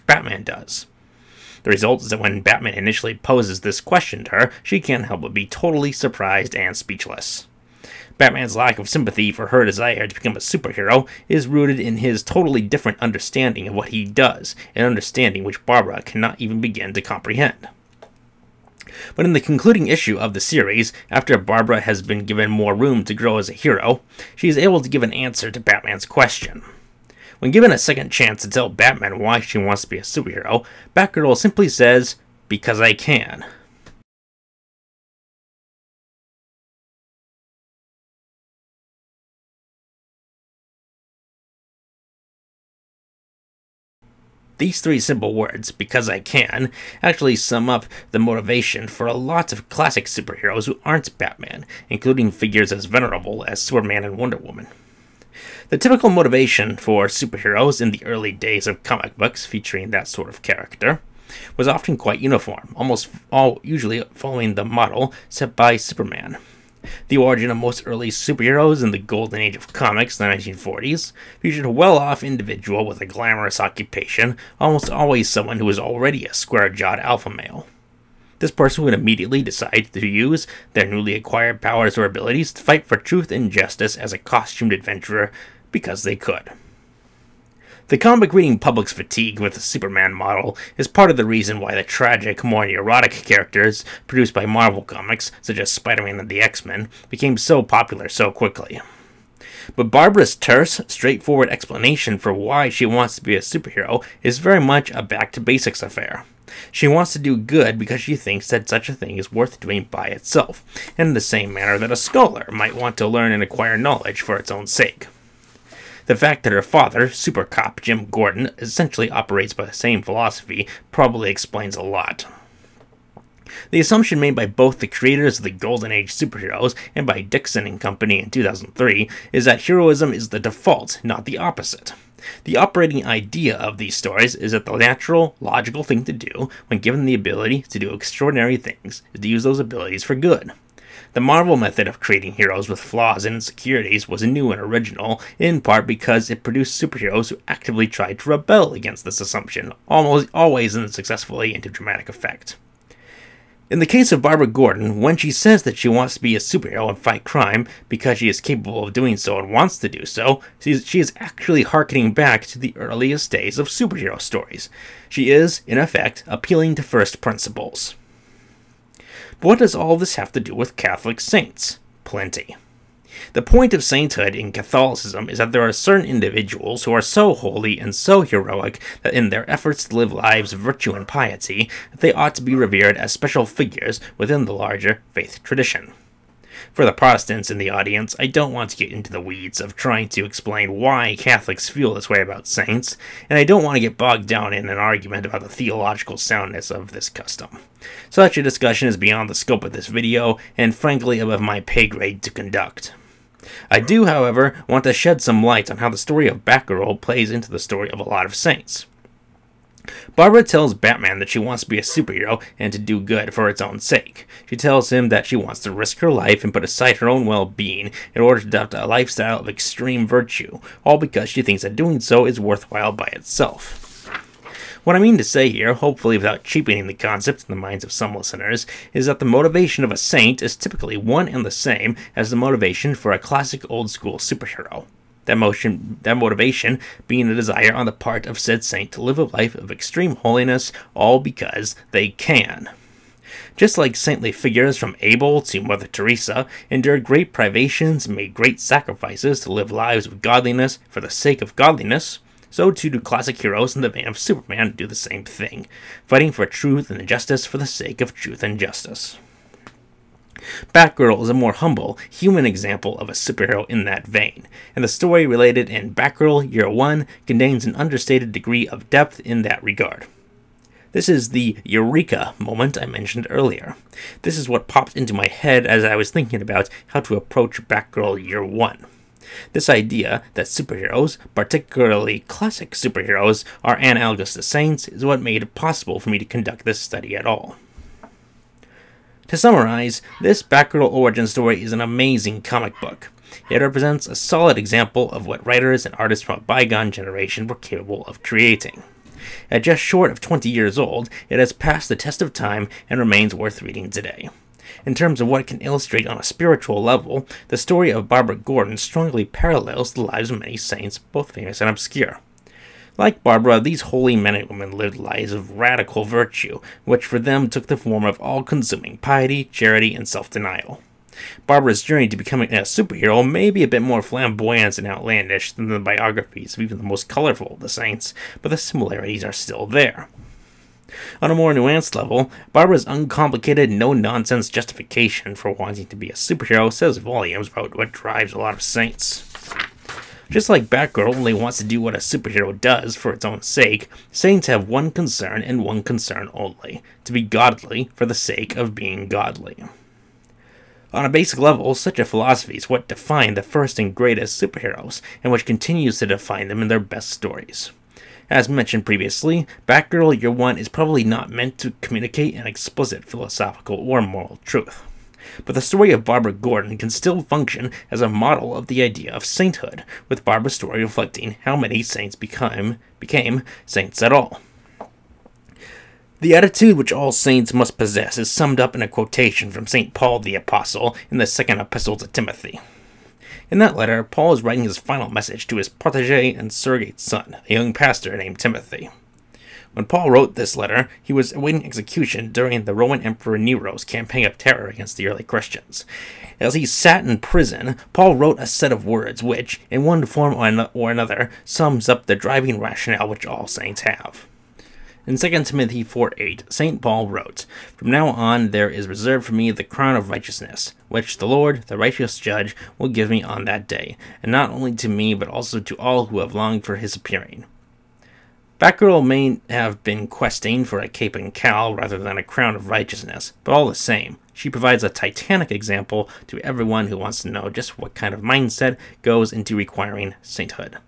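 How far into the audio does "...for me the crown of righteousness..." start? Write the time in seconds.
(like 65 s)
409 s.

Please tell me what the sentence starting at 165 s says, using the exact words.
She is, in effect, appealing to first principles what does all this have to do with Catholic saints?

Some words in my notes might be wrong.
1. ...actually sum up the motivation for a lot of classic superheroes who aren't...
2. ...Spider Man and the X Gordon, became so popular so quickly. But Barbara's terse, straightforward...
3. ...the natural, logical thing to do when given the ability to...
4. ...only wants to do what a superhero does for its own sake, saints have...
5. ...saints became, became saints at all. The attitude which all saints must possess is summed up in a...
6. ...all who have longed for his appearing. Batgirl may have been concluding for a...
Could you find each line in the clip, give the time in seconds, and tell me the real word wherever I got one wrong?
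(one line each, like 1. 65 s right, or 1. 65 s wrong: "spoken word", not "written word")
1. 47 s right
2. 95 s wrong: "Men", not "Gordon"
3. 134 s right
4. 341 s right
5. 371 s right
6. 415 s wrong: "questing", not "concluding".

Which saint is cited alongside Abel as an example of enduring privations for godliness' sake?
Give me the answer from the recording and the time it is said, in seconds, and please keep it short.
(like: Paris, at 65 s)
Mother Teresa, at 245 s.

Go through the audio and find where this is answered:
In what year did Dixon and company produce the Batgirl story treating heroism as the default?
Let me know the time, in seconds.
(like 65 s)
128 s.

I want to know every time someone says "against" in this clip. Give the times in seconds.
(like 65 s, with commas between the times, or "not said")
148 s, 394 s.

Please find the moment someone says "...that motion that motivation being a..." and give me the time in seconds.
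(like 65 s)
235 s.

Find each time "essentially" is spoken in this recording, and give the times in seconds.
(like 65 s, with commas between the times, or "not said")
118 s.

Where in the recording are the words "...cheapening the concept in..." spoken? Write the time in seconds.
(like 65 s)
226 s.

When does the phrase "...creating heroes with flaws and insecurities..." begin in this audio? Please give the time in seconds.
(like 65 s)
141 s.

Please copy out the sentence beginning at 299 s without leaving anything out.
At just short of 20 years old, it has passed the test of time and remains worth reading today.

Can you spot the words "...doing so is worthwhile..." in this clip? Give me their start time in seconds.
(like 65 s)
221 s.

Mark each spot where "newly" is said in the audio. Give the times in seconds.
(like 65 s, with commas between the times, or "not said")
80 s.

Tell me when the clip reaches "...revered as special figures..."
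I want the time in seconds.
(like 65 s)
182 s.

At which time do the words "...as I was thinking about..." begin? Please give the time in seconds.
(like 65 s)
275 s.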